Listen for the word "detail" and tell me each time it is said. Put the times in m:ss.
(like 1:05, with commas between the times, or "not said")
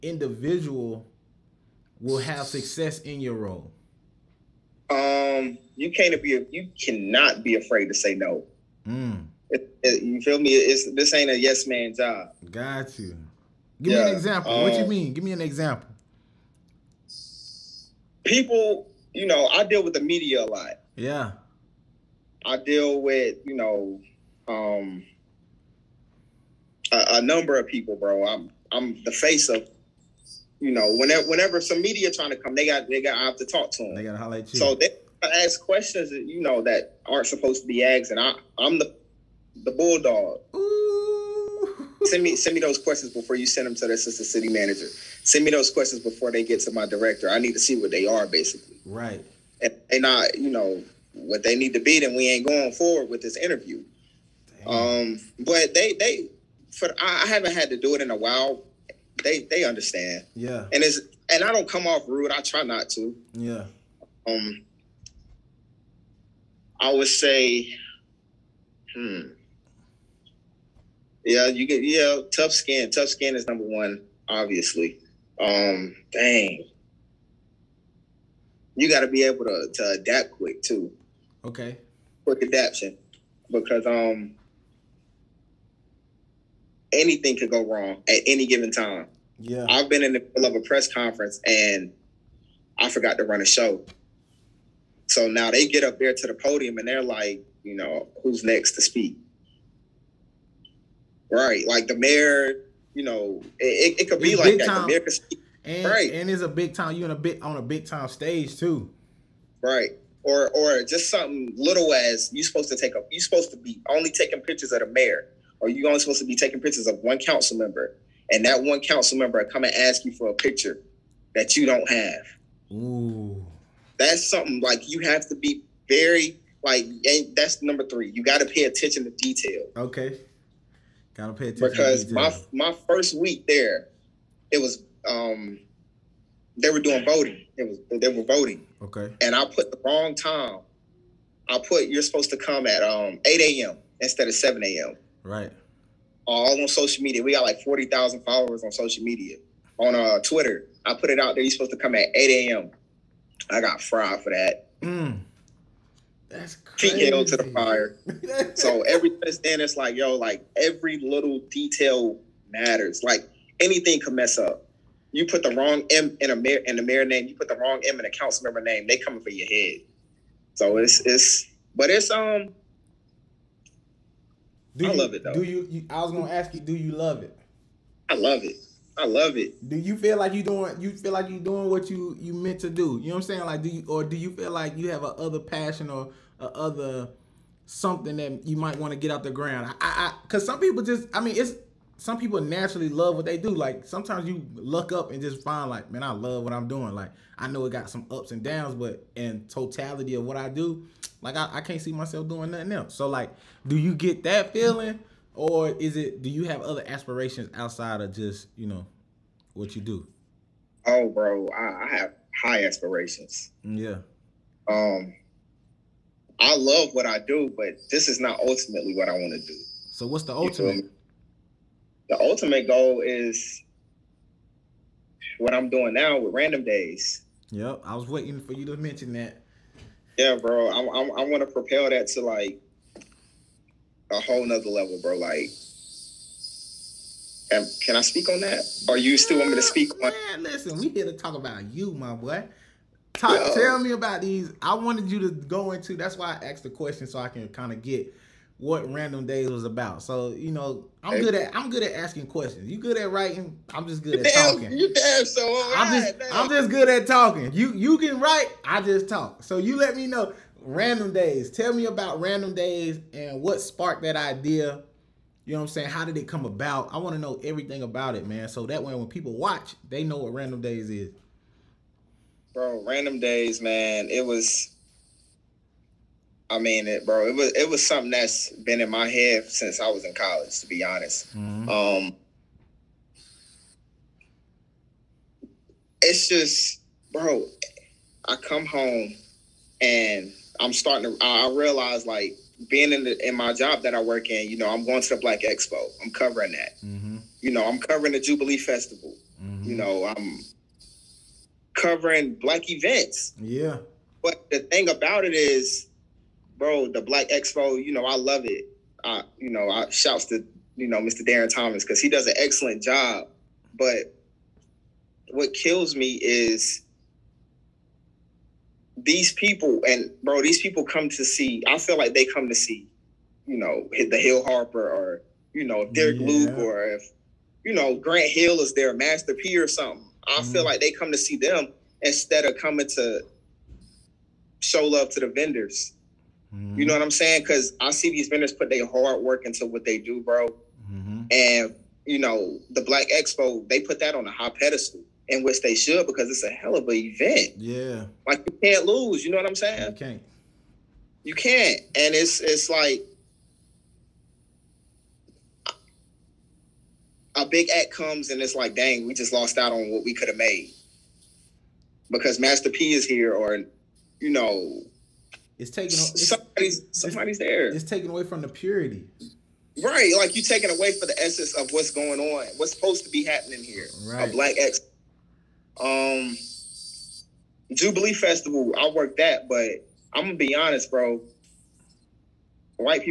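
2:09, 2:41.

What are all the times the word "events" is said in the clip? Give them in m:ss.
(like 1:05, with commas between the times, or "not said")
5:02, 5:46.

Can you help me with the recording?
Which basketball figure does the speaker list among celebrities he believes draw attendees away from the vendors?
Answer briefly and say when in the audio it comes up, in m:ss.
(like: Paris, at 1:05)
Grant Hill, at 5:27.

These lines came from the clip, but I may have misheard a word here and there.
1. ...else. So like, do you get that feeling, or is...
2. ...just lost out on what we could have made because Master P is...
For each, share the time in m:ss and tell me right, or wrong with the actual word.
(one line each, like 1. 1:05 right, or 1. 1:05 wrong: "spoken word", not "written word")
1. 3:22 right
2. 5:59 right.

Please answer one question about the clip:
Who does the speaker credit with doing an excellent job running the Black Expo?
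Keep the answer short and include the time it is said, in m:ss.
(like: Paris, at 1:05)
Darrin Thomas, at 5:10.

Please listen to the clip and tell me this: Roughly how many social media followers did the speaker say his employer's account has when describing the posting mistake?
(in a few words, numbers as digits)
40,000.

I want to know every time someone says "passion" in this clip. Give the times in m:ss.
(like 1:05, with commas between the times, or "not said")
3:05.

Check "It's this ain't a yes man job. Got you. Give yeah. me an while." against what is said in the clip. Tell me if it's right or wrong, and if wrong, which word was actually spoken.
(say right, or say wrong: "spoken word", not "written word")
wrong: "example", not "while".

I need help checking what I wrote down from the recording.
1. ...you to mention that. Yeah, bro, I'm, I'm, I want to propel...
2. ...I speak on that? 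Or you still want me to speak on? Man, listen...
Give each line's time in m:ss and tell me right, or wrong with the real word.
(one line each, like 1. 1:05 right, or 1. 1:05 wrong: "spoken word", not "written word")
1. 3:48 right
2. 3:57 right.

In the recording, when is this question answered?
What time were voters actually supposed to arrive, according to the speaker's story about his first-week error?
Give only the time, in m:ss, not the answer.
2:24.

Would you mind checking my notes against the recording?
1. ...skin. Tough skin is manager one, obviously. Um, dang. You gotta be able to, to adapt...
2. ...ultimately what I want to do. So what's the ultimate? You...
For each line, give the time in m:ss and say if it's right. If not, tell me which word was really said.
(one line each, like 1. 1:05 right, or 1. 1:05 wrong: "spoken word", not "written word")
1. 1:12 wrong: "number", not "manager"
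2. 3:38 right.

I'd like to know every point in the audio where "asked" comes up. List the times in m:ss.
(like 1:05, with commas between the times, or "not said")
0:37, 4:06.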